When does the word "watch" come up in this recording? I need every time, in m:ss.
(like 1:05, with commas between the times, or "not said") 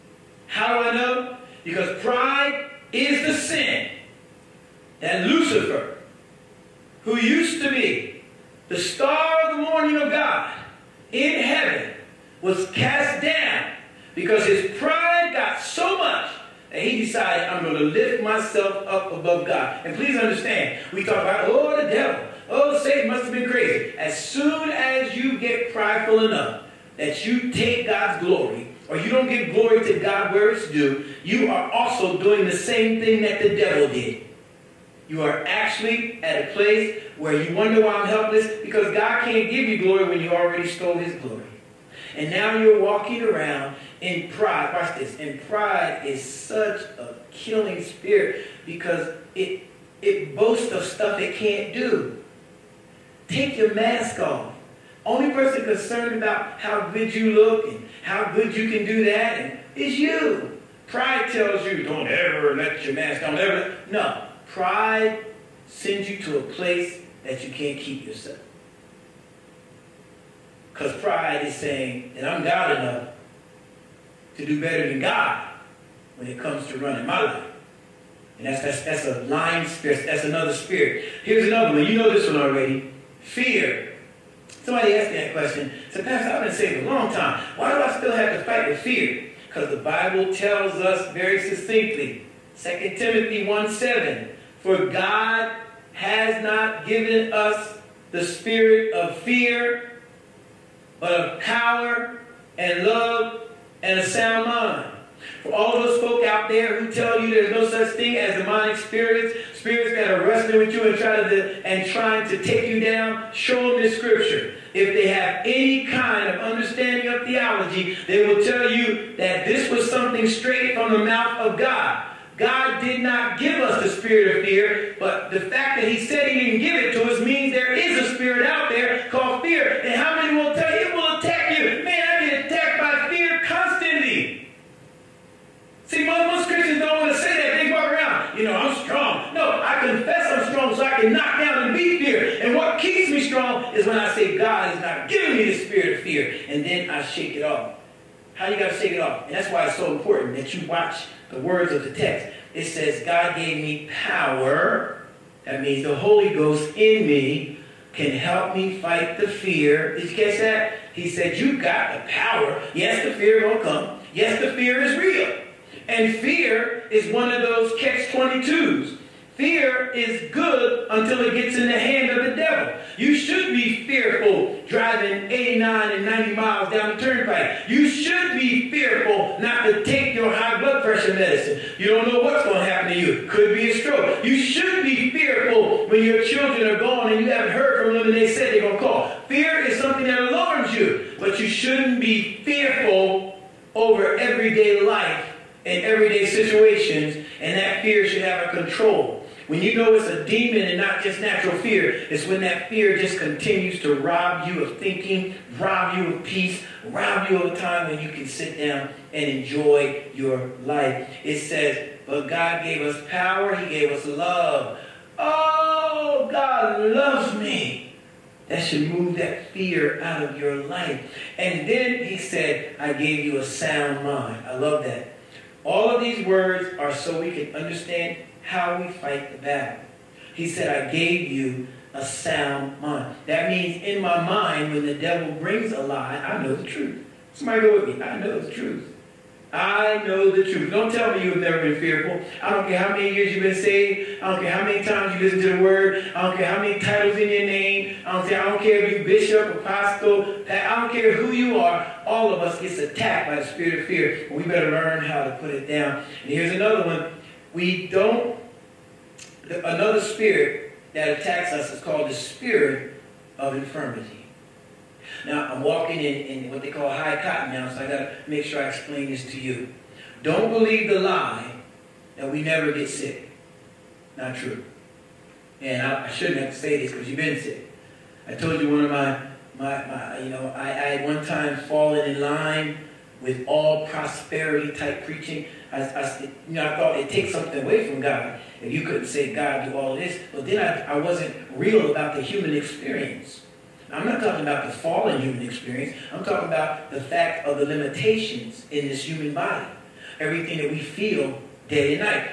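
0:44, 2:30.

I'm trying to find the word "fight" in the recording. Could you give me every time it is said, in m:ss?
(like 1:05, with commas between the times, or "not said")
1:28, 2:38, 3:48.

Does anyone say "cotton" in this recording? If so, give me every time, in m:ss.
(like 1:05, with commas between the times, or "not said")
4:27.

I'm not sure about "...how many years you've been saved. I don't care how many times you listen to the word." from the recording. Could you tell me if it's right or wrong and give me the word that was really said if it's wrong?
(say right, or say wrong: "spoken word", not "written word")
right.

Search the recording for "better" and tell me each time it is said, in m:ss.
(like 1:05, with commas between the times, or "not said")
1:14, 4:14.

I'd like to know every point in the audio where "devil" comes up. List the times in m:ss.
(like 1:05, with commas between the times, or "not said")
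0:21, 0:33, 2:52, 3:54.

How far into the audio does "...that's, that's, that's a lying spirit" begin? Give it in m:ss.
1:18.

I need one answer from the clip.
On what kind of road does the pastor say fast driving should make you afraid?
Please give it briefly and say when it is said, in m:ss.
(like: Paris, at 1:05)
Turnpike, at 2:57.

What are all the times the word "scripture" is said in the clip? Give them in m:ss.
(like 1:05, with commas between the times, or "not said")
1:53.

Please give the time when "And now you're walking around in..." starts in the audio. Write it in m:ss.
0:42.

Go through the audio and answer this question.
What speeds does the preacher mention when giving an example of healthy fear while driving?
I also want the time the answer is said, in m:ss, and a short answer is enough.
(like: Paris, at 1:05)
89 and 90 miles, at 2:55.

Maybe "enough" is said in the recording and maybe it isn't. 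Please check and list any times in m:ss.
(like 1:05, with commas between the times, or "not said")
0:26, 1:12.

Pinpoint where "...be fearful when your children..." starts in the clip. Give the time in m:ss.
3:04.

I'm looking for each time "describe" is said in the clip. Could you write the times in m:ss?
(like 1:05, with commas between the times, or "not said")
not said.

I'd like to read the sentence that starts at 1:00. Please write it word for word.
Pride tells you don't ever let your mask, don't ever.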